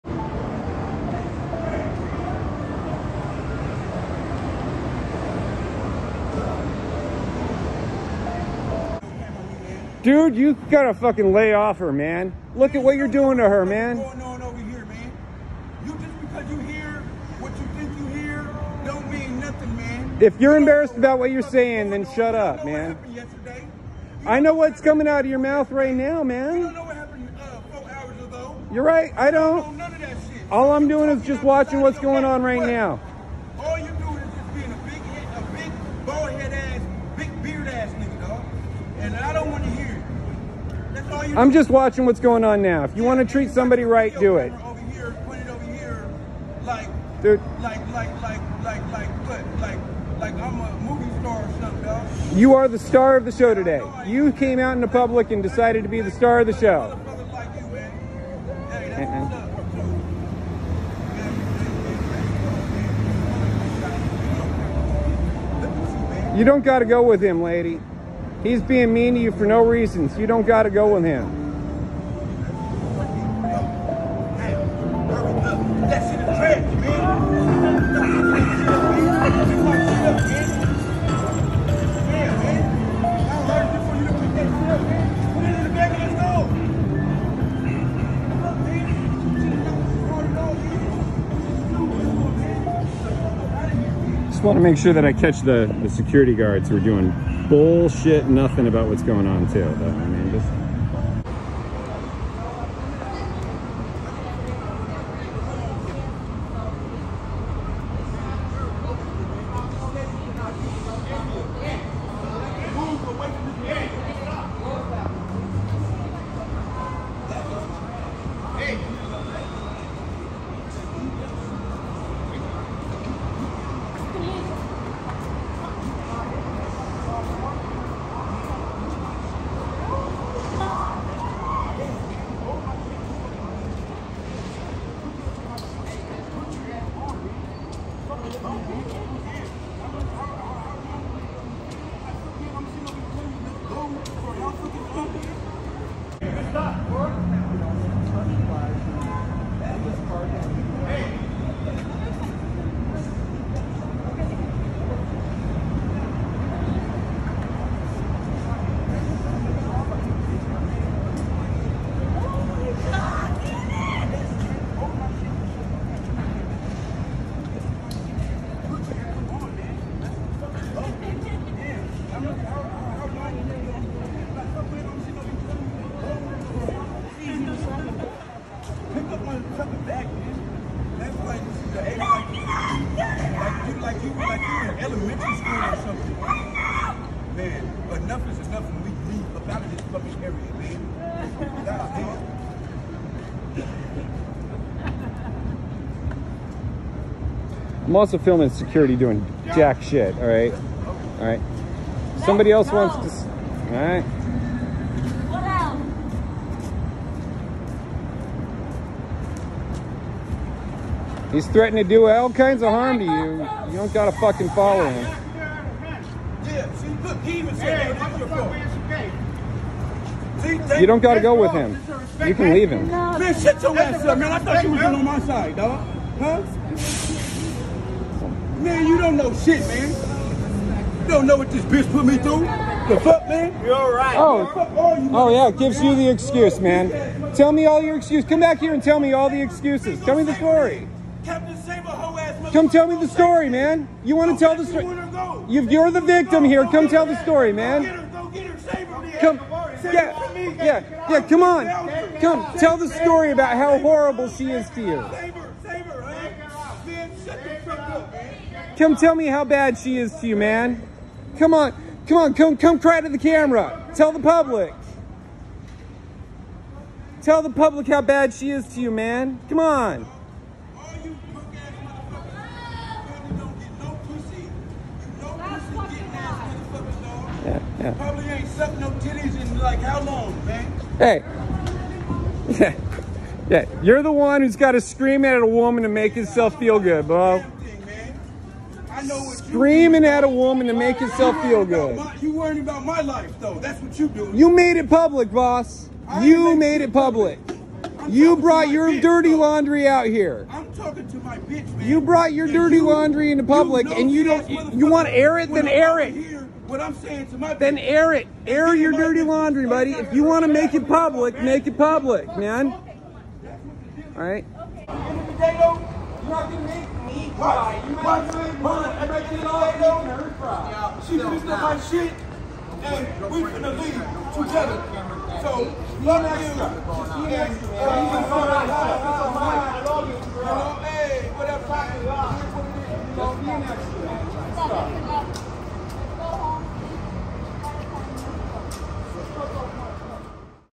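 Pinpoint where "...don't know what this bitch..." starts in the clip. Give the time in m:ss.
3:51.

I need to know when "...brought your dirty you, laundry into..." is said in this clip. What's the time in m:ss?
5:02.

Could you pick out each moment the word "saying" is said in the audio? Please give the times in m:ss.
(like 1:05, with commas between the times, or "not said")
0:21, 5:06.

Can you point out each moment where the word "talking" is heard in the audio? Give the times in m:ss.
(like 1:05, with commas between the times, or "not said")
5:00.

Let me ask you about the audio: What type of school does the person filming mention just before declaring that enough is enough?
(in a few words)
elementary school.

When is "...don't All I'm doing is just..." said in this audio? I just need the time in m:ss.
0:29.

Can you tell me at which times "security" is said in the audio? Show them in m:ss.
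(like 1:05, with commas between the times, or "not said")
1:35, 3:18.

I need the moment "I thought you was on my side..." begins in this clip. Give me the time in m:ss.
3:44.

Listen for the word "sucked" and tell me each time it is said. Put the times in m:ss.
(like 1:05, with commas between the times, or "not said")
4:38.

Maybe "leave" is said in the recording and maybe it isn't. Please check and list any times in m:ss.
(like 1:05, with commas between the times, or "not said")
3:09, 3:42, 5:23.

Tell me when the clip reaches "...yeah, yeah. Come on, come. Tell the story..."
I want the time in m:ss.
4:10.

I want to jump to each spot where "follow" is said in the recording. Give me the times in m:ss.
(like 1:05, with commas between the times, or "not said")
3:34.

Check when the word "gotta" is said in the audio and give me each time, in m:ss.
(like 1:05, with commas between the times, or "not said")
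0:10, 3:33, 3:41.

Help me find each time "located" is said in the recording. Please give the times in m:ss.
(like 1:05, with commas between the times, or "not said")
not said.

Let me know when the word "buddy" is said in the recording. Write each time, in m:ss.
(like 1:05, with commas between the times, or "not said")
5:09.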